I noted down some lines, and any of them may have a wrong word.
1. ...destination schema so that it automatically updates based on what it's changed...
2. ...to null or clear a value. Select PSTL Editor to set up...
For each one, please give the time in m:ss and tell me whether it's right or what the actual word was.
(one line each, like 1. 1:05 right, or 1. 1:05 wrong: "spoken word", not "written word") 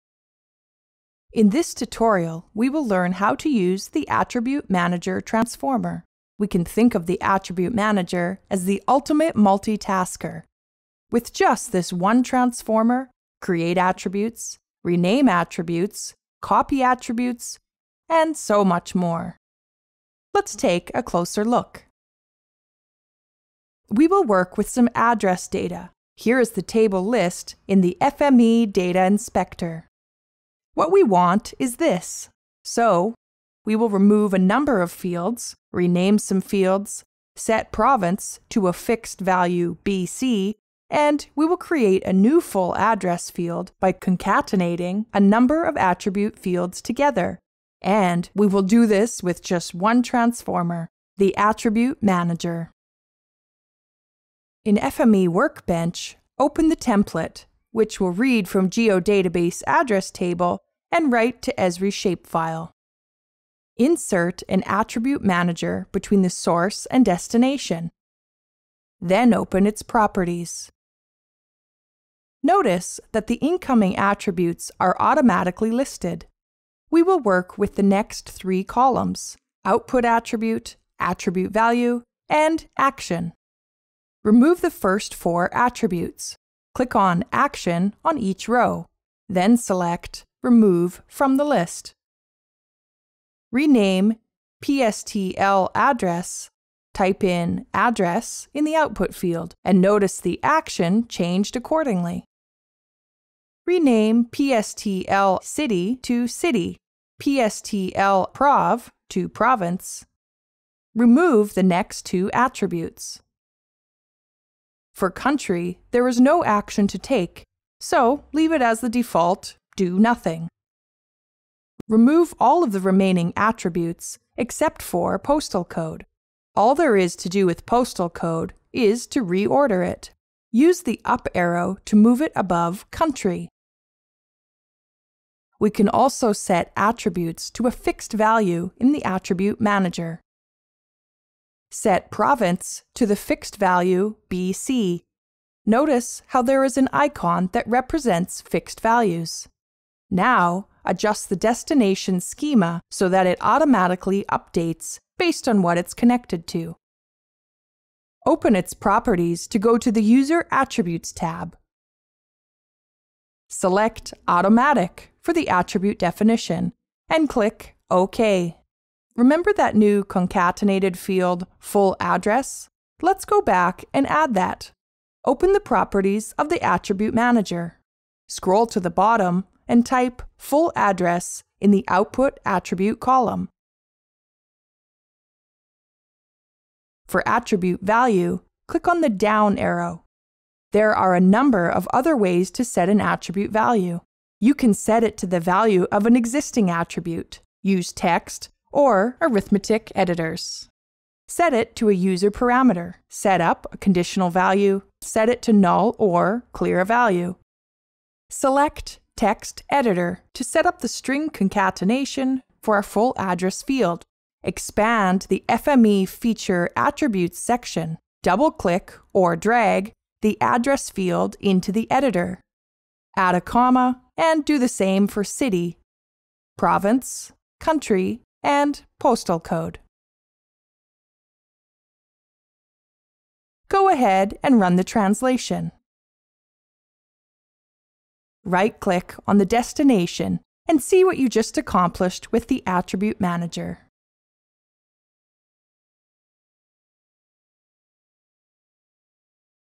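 1. 2:31 wrong: "connected", not "changed"
2. 3:25 wrong: "Text", not "PSTL".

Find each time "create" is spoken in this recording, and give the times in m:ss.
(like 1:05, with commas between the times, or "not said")
0:13, 0:41.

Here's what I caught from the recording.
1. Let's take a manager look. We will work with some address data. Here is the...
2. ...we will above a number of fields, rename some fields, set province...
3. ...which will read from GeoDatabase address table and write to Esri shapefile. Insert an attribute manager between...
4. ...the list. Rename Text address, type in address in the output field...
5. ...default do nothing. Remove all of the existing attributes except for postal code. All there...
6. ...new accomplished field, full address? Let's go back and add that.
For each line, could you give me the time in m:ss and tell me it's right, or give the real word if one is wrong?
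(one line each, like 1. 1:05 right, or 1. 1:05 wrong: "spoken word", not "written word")
1. 0:20 wrong: "closer", not "manager"
2. 0:33 wrong: "remove", not "above"
3. 0:57 right
4. 1:31 wrong: "PSTL", not "Text"
5. 1:58 wrong: "remaining", not "existing"
6. 2:49 wrong: "concatenated", not "accomplished".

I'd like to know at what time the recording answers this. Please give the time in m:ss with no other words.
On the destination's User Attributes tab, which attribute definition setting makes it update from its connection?
2:44.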